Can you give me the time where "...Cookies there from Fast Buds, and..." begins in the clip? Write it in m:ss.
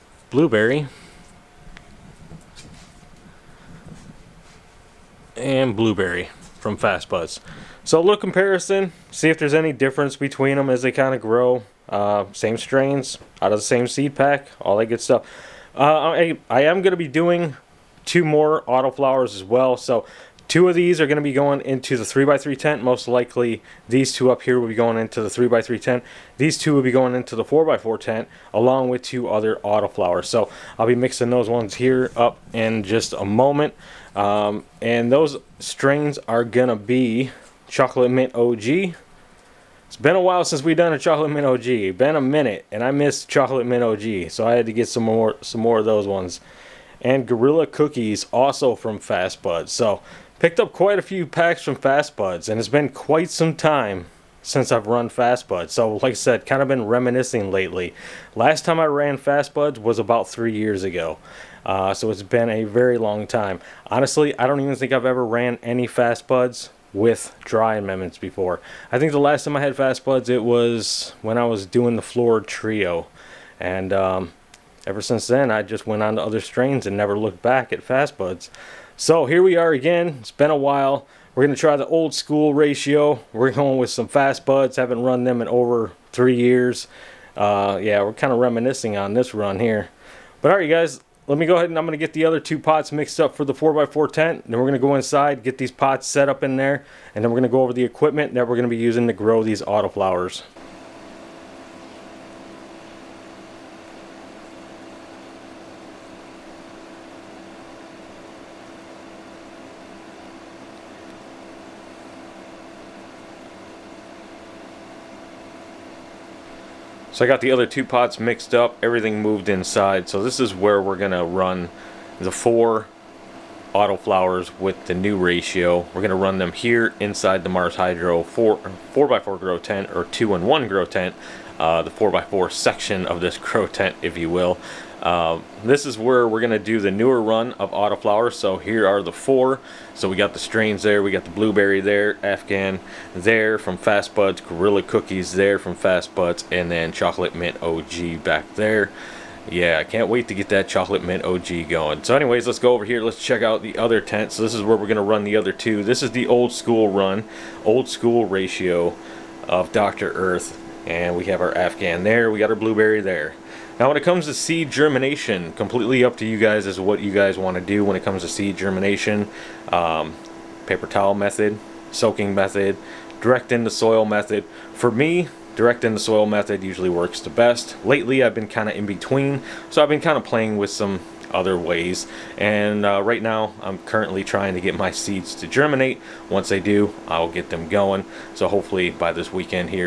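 2:24.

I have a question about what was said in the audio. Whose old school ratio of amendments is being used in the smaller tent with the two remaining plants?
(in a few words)
Dr. Earth.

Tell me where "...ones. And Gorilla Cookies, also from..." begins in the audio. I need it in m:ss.
0:46.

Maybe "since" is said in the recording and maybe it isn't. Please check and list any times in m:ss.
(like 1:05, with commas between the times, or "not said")
0:40, 0:54, 1:15.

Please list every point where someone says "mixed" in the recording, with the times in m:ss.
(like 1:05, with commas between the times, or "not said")
1:32, 1:58.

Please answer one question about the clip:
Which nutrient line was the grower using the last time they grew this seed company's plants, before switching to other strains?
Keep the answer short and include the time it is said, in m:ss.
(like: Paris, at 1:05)
Flora trio, at 1:12.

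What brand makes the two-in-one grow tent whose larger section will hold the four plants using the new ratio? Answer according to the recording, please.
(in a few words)
Mars Hydro.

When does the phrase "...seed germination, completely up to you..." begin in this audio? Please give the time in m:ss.
2:44.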